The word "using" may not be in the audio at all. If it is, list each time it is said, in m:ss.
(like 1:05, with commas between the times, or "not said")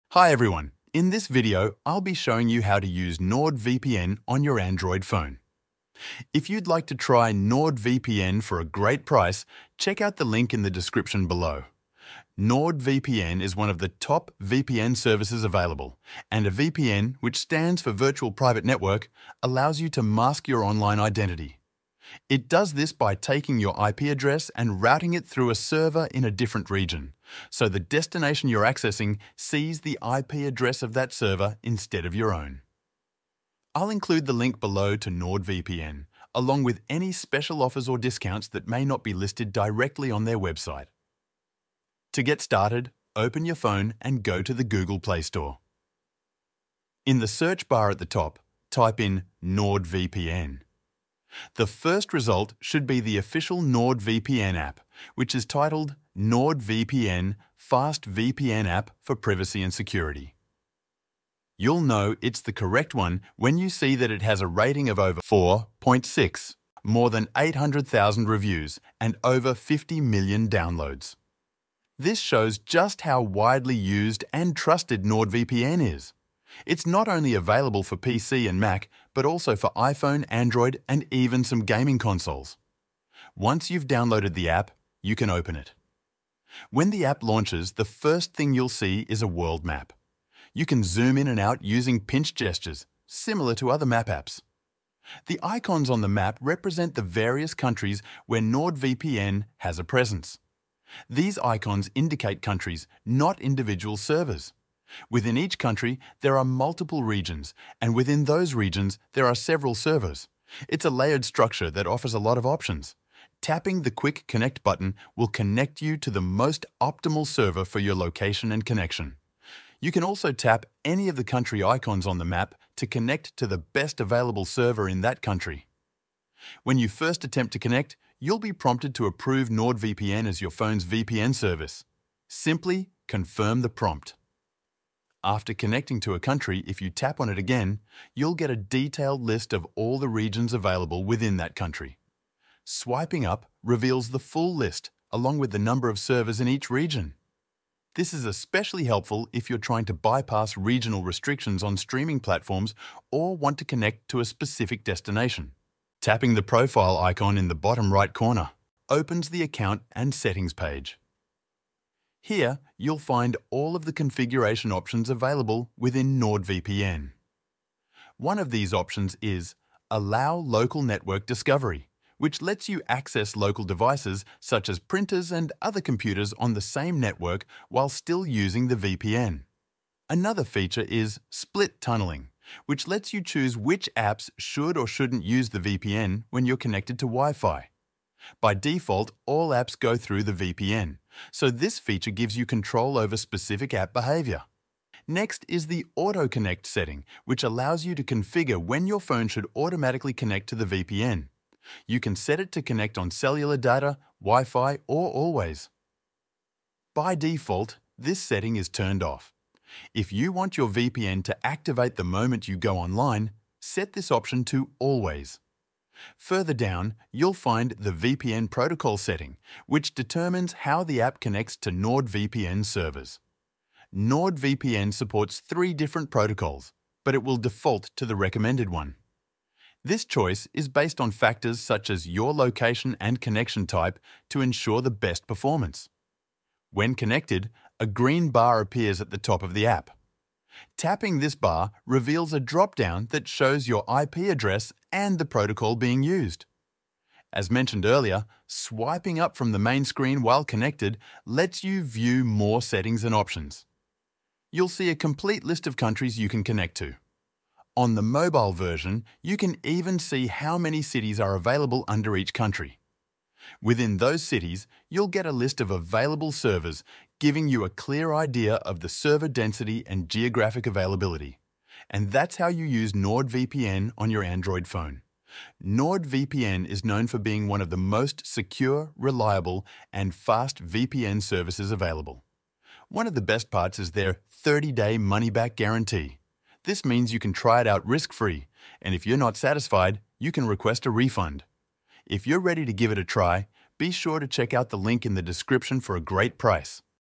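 1:31, 2:58.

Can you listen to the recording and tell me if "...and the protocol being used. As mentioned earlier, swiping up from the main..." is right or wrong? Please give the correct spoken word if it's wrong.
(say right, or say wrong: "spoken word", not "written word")
right.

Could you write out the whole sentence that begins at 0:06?
If you'd like to try NordVPN for a great price, check out the link in the description below.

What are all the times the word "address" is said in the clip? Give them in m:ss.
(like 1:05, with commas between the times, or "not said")
0:24, 0:30, 4:04.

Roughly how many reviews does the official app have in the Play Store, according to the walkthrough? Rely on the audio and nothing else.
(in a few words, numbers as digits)
800,000.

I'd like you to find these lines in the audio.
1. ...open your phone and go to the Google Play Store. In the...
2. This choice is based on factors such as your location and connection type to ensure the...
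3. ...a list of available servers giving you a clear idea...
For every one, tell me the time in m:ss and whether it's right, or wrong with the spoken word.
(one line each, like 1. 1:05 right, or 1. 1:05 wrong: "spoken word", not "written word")
1. 0:43 right
2. 3:49 right
3. 4:25 right.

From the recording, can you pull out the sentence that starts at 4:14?
You'll see a complete list of countries you can connect to.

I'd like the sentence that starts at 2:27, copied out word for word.
This is especially helpful if you're trying to bypass regional restrictions on streaming platforms or want to connect to a specific destination.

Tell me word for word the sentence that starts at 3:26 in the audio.
By default, this setting is turned off.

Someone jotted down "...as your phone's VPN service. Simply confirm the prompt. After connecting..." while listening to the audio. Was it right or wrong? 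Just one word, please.
right.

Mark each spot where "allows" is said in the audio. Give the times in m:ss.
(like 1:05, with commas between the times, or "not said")
0:19, 2:49, 3:17.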